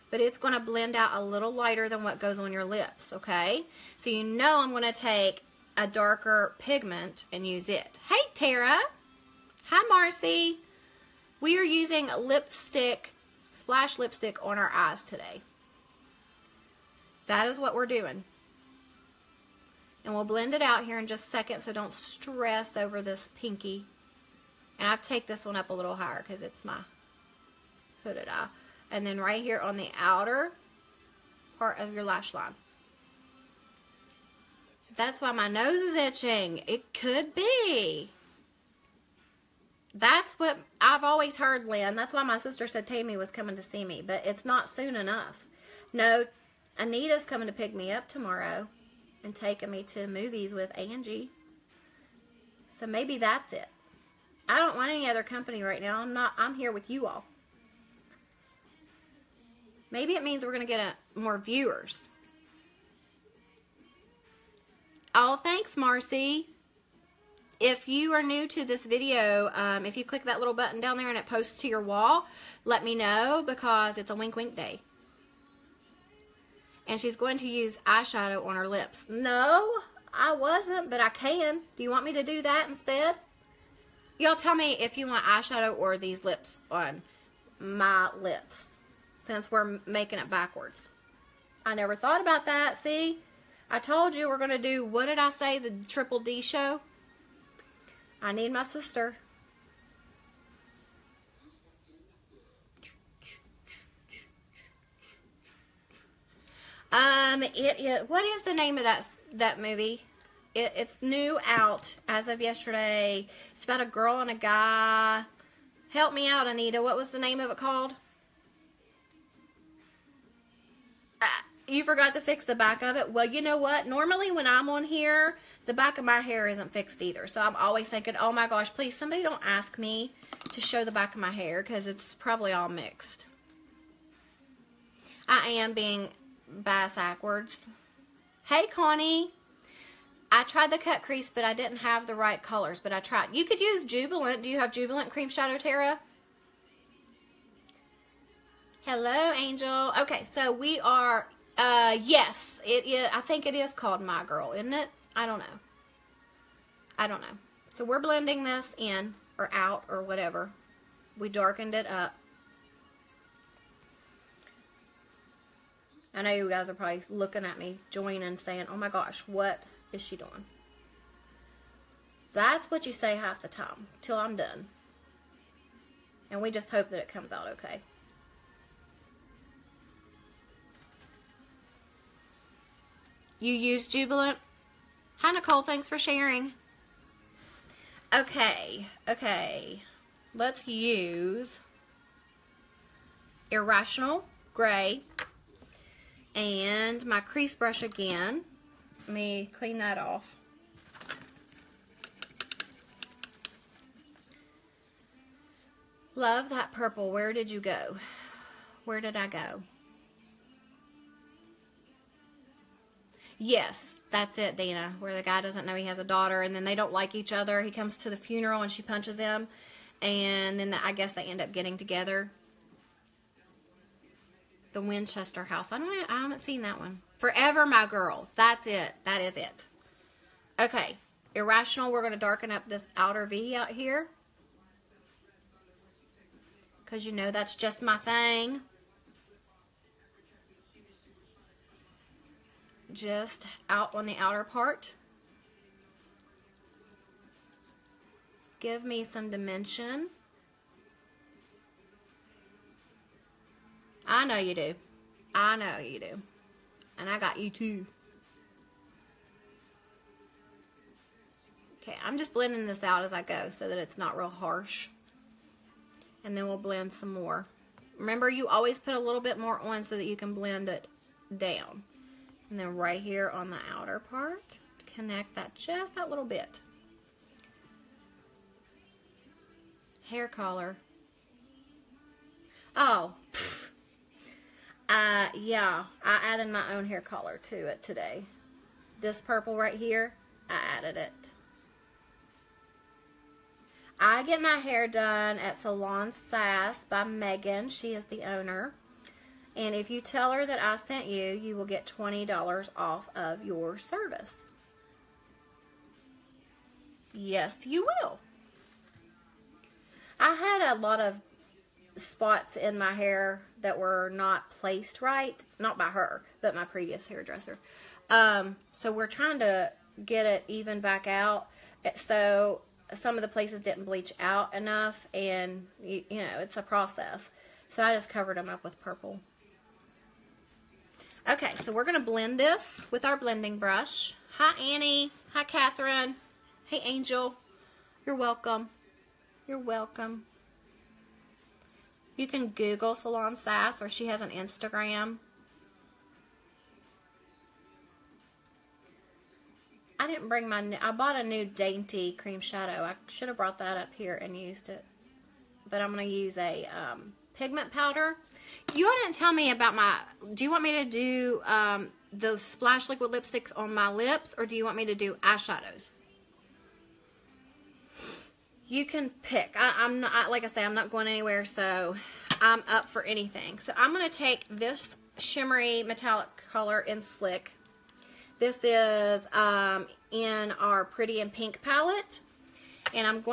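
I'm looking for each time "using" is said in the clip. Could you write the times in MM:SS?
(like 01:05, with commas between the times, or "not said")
00:11.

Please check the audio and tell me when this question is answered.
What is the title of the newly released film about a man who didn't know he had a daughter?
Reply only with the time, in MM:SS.
03:47.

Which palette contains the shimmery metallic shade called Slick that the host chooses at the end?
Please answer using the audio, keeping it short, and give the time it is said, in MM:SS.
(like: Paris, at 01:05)
Pretty and Pink, at 06:20.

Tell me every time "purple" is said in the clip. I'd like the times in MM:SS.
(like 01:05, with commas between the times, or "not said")
03:26, 04:49, 05:28.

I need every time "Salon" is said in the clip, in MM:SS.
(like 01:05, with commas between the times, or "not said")
04:55, 05:42.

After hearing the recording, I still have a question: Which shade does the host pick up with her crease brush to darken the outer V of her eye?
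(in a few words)
Irrational Gray.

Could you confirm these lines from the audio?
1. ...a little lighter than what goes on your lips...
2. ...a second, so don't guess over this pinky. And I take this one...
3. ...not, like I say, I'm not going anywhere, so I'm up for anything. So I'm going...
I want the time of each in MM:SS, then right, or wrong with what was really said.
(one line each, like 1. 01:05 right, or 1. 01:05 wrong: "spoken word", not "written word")
1. 00:01 right
2. 00:21 wrong: "stress", not "guess"
3. 06:10 right.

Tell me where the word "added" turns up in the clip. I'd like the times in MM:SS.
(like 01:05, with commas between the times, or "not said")
04:46, 04:50.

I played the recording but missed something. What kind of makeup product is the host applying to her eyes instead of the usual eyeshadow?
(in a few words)
Splash lipstick.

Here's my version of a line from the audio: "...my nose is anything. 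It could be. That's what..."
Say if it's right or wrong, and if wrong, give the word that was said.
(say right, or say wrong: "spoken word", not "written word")
wrong: "itching", not "anything".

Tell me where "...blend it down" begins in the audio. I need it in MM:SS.
04:30.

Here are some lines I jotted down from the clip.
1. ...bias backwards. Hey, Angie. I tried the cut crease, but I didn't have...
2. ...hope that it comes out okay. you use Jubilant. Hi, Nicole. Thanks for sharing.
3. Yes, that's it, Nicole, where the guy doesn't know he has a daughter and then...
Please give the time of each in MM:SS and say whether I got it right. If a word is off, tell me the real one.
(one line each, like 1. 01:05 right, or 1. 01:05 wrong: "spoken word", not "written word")
1. 02:16 wrong: "Connie", not "Angie"
2. 02:56 right
3. 03:33 wrong: "Dana", not "Nicole".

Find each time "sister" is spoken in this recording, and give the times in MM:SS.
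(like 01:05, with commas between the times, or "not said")
00:42, 01:38.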